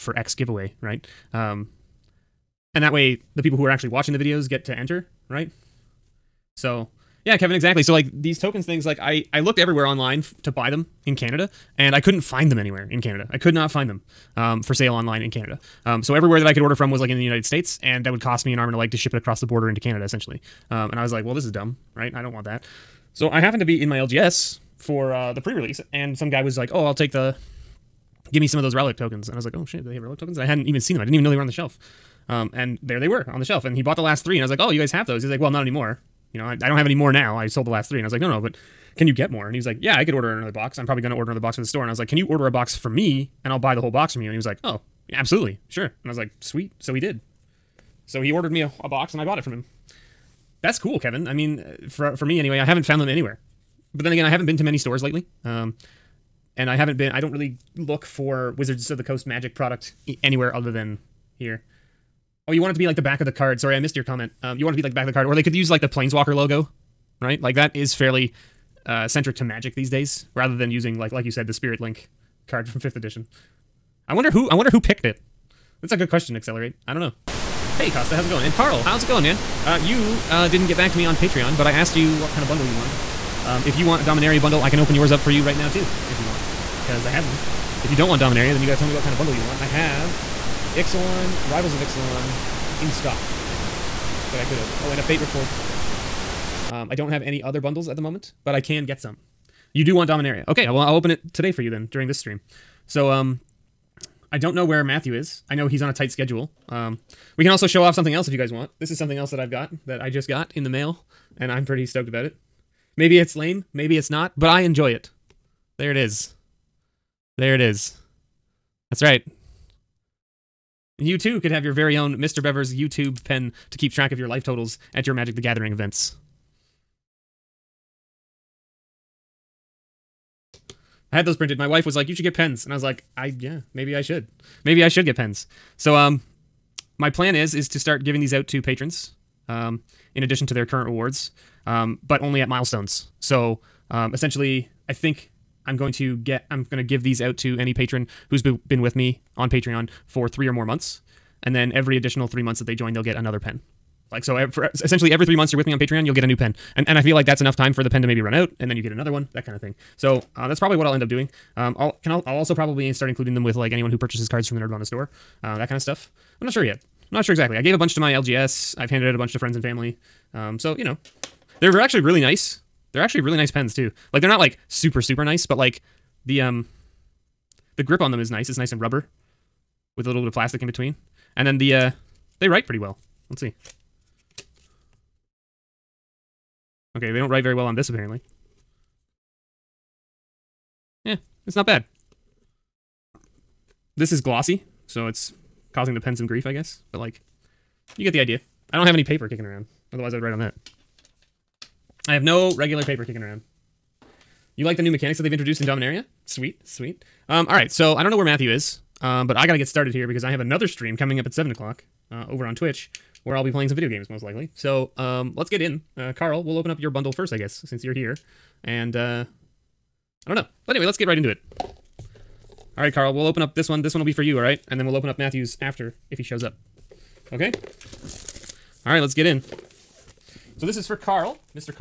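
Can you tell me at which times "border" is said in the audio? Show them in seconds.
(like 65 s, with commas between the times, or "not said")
19 s.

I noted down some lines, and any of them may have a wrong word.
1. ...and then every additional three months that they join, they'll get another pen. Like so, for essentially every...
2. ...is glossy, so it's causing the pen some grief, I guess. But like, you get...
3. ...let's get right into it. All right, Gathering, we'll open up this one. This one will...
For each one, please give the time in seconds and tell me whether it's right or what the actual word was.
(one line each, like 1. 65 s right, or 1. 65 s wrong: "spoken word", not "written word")
1. 151 s right
2. 194 s right
3. 220 s wrong: "Carl", not "Gathering".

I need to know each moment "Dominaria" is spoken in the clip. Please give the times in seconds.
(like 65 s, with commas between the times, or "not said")
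84 s, 88 s, 100 s, 205 s.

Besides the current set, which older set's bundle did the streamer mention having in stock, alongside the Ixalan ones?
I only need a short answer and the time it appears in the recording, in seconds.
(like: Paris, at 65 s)
Fate Reforged, at 95 s.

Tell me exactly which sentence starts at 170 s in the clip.
Um, so you know, they're actually really nice.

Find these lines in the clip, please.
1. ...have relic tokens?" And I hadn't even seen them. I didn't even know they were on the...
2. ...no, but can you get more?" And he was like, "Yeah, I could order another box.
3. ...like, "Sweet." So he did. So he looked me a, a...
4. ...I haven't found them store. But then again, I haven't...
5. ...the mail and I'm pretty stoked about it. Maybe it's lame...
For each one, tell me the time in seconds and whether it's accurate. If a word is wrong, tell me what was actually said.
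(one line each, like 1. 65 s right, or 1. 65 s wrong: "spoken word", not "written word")
1. 29 s right
2. 38 s right
3. 46 s wrong: "ordered", not "looked"
4. 52 s wrong: "anywhere", not "store"
5. 110 s right.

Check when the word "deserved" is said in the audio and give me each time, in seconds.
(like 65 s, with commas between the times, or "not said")
not said.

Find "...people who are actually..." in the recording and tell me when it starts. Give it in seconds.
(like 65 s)
3 s.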